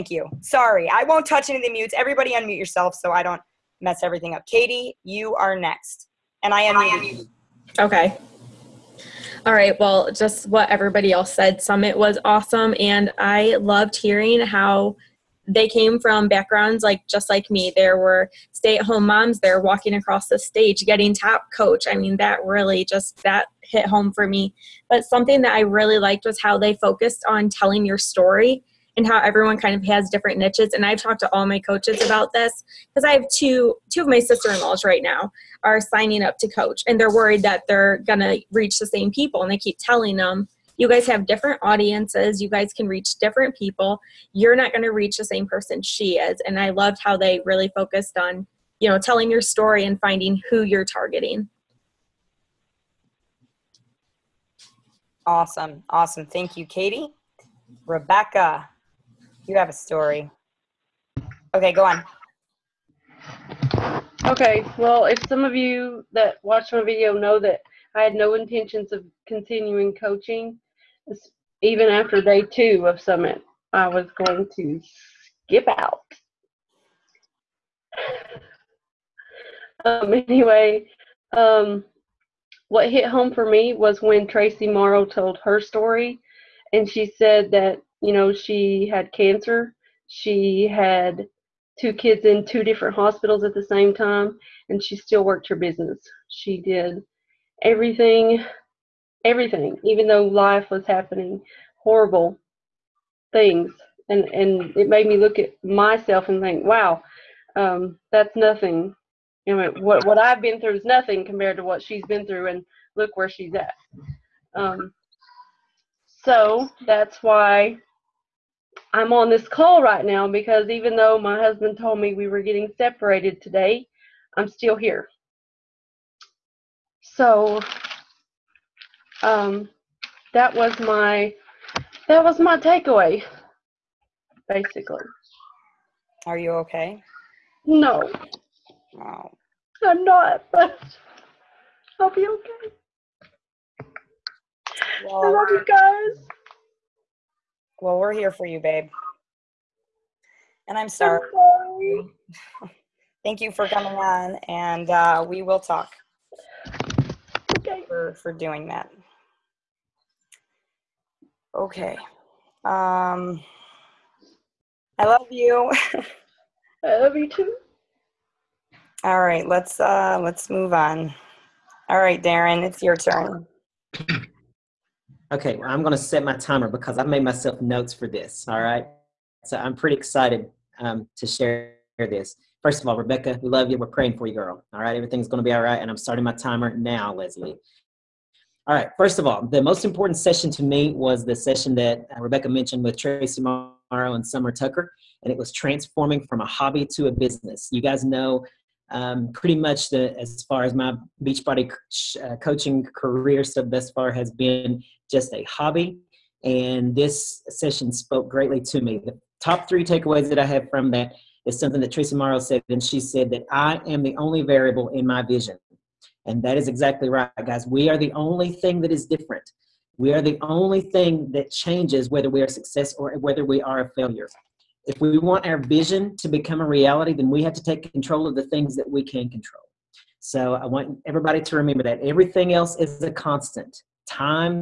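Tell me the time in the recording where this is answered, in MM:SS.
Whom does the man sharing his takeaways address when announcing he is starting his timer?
03:07.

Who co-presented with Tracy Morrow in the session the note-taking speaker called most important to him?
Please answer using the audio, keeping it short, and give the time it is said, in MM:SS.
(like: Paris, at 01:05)
Summer Tucker, at 03:14.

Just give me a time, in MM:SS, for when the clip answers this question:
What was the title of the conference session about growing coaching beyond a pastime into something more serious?
03:15.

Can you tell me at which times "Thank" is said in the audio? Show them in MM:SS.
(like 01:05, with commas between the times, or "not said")
00:56, 02:33.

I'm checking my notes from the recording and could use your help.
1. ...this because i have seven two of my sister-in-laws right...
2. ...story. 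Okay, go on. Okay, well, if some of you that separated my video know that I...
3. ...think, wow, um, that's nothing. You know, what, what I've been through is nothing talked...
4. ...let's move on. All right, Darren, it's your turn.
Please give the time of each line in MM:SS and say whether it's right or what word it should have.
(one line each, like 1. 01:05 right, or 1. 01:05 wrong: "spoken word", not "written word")
1. 00:32 wrong: "two", not "seven"
2. 00:59 wrong: "watched", not "separated"
3. 01:46 wrong: "compared", not "talked"
4. 02:50 right.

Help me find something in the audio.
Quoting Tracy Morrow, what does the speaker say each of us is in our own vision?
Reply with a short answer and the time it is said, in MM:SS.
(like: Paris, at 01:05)
The only variable, at 03:34.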